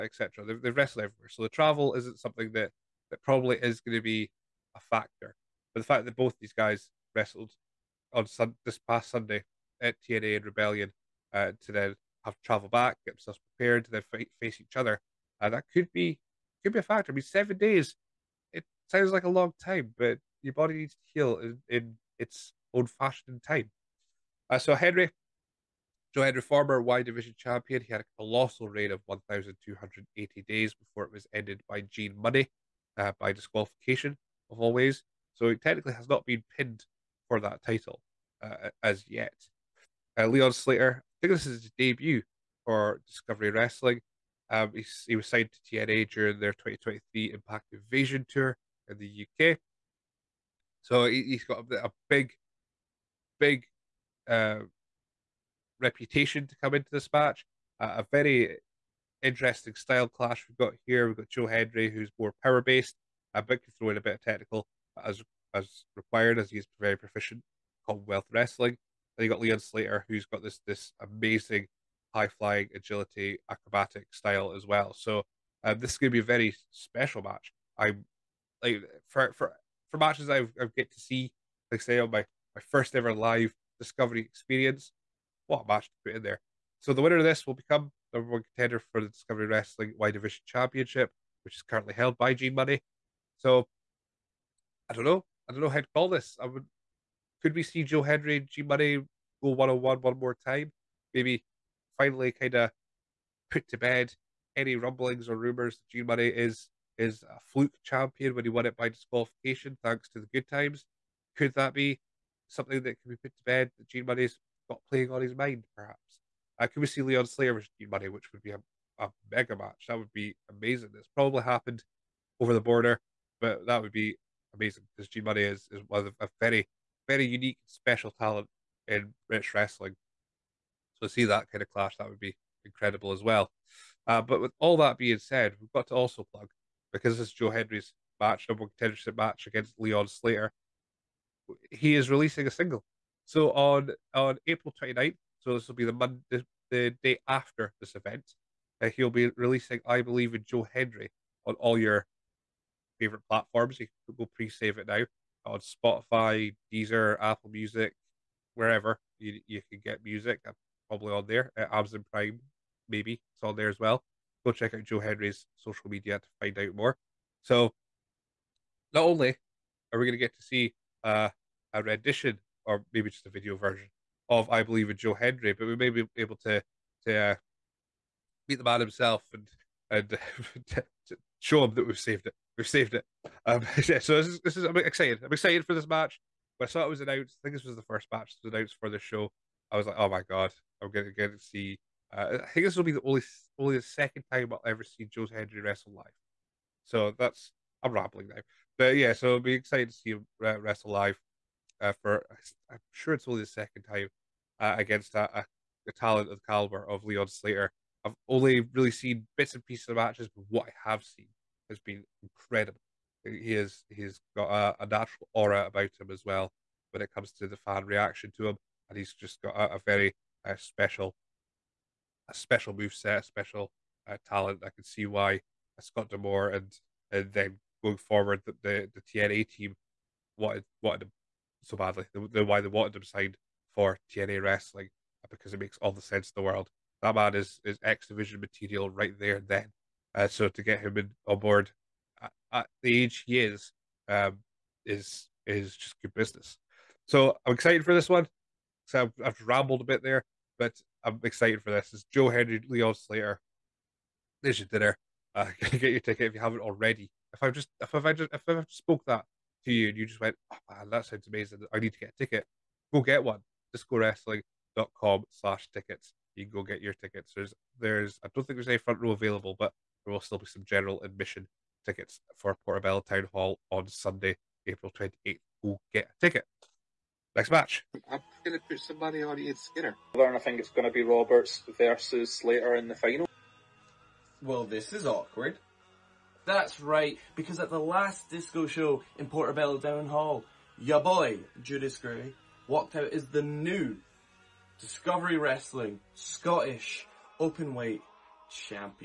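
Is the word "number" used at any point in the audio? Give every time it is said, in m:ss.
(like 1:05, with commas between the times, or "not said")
1:28, 2:18.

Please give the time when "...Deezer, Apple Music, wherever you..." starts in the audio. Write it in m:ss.
2:36.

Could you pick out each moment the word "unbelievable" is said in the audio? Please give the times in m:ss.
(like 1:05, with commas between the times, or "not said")
not said.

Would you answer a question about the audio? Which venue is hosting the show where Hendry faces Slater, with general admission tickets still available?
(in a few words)
Portobello Town Hall.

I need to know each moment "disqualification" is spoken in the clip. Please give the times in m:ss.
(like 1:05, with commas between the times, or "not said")
0:33, 1:48.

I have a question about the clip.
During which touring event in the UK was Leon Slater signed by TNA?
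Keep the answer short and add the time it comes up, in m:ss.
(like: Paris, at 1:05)
2023 Impact Invasion Tour, at 0:46.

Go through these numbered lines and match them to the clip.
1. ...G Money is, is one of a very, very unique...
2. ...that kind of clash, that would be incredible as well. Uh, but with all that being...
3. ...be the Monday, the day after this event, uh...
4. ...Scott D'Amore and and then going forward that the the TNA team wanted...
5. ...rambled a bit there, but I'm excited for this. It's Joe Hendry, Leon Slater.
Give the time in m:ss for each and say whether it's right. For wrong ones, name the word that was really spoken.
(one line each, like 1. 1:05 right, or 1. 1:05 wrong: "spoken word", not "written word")
1. 2:05 right
2. 2:11 right
3. 2:25 right
4. 3:45 right
5. 4:09 right.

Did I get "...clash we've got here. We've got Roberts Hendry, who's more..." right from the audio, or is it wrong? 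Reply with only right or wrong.
wrong.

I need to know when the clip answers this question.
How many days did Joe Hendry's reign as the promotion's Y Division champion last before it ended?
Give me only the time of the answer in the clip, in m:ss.
0:29.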